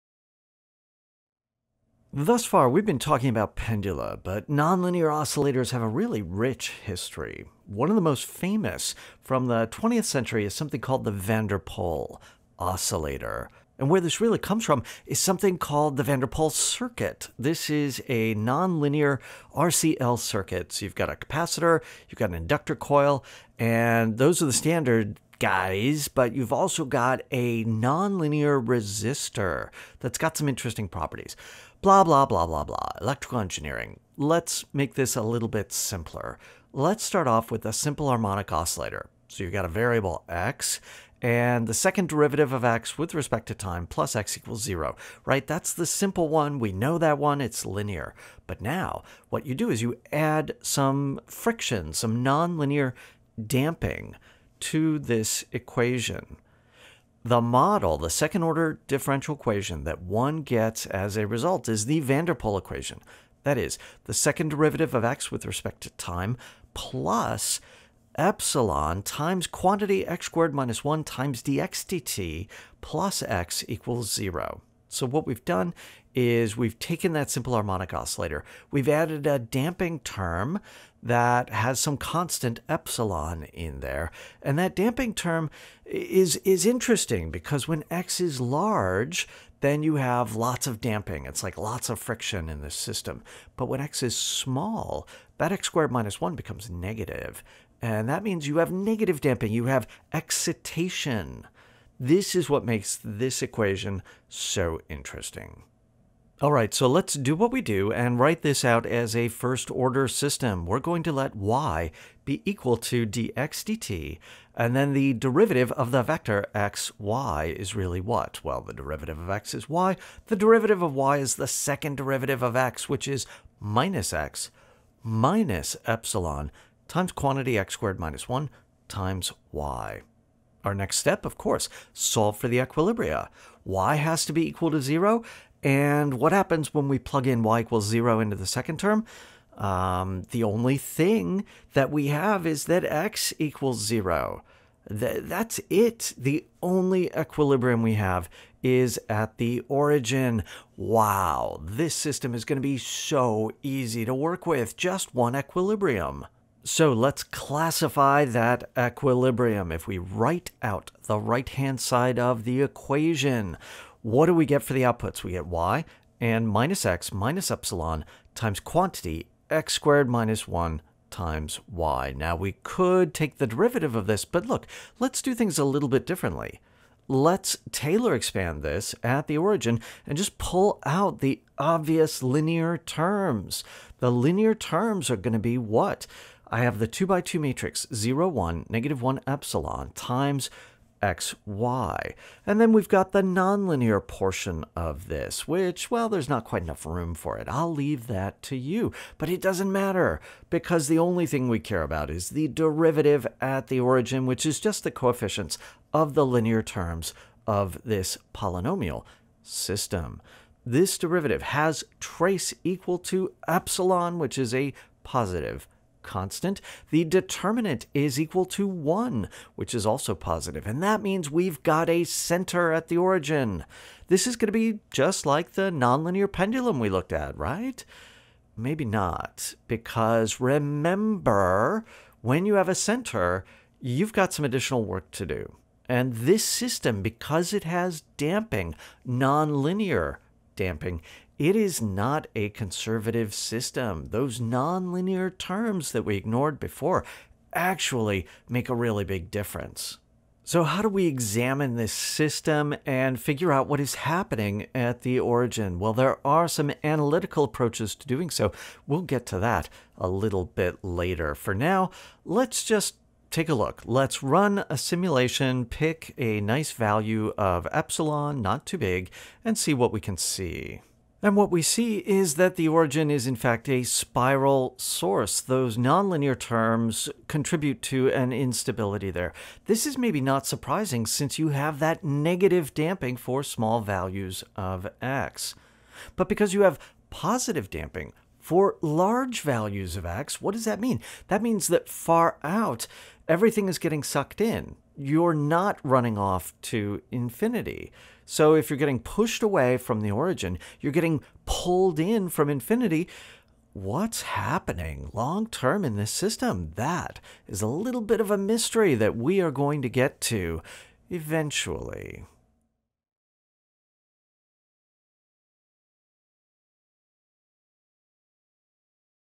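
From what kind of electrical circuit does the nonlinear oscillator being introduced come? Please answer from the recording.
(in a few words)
nonlinear RCL circuit.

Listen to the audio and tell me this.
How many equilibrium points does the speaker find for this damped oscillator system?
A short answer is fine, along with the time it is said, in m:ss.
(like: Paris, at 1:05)
1, at 2:34.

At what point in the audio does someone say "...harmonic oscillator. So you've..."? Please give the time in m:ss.
0:38.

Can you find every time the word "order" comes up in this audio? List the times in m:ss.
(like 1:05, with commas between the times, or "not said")
0:58, 1:49.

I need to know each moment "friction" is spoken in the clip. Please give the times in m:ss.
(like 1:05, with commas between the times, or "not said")
0:51, 1:31.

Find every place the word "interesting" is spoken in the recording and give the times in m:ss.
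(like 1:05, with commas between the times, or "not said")
0:30, 1:26, 1:44.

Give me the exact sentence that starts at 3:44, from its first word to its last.
This is going to be just like the nonlinear pendulum we looked at, right?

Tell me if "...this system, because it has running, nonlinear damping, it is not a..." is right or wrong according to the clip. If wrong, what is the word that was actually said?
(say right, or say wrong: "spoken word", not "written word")
wrong: "damping", not "running".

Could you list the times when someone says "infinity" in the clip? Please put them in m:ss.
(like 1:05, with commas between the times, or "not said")
4:57, 5:02.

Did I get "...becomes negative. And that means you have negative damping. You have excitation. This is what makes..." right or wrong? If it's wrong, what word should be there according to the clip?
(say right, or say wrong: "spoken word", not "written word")
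right.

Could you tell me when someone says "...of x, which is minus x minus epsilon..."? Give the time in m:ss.
2:02.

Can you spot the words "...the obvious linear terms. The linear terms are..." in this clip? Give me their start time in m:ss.
3:01.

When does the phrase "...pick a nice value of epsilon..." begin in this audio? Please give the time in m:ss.
4:25.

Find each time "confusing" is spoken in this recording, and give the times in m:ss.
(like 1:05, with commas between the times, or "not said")
not said.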